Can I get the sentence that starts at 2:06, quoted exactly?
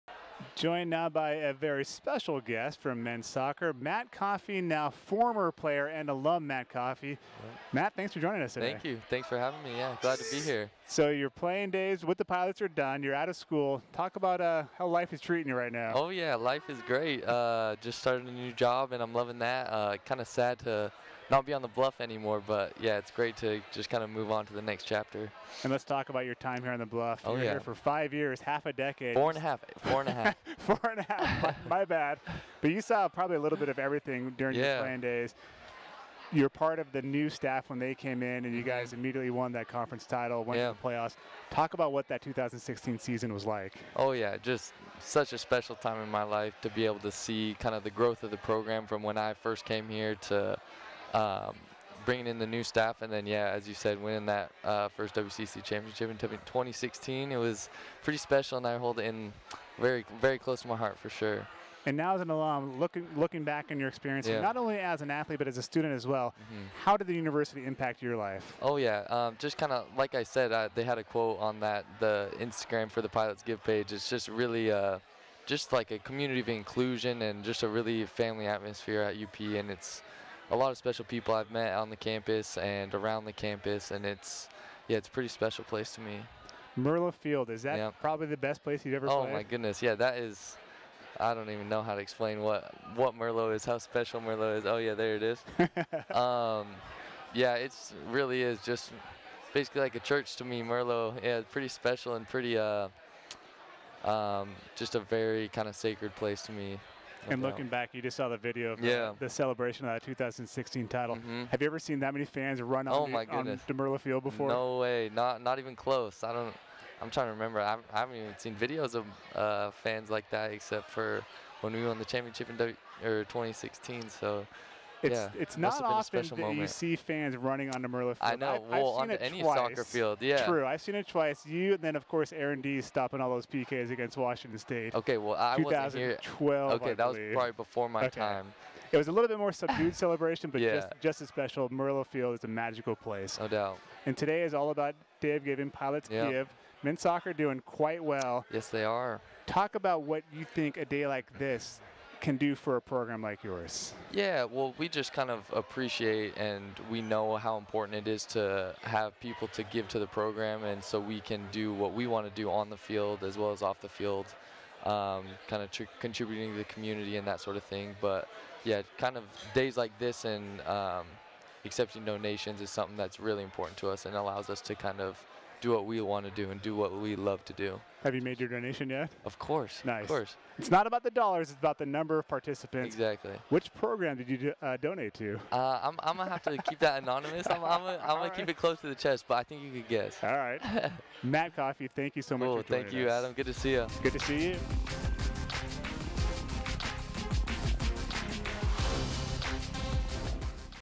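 you see fans running on Merlo field.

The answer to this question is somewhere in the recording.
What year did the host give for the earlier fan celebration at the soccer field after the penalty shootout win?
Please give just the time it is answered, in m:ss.
2:16.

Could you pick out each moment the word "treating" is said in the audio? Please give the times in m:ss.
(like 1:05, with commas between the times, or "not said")
0:15.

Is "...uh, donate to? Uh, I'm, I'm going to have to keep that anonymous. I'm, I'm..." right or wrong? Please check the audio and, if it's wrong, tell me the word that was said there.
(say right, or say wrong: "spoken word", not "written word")
right.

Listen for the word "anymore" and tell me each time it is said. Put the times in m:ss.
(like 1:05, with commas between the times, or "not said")
0:22.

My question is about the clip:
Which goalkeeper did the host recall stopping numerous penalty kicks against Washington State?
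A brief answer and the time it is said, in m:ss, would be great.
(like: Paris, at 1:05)
Aaron D, at 2:12.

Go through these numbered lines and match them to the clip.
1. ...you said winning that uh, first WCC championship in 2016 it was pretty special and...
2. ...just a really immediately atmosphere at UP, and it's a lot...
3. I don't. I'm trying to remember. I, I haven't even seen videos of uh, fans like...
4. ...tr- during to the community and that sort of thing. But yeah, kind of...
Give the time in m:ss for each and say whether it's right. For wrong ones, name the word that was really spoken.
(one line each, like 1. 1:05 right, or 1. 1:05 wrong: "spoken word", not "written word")
1. 0:53 right
2. 1:17 wrong: "family", not "immediately"
3. 1:56 right
4. 2:45 wrong: "contributing", not "during".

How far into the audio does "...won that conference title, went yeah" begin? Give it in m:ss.
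0:39.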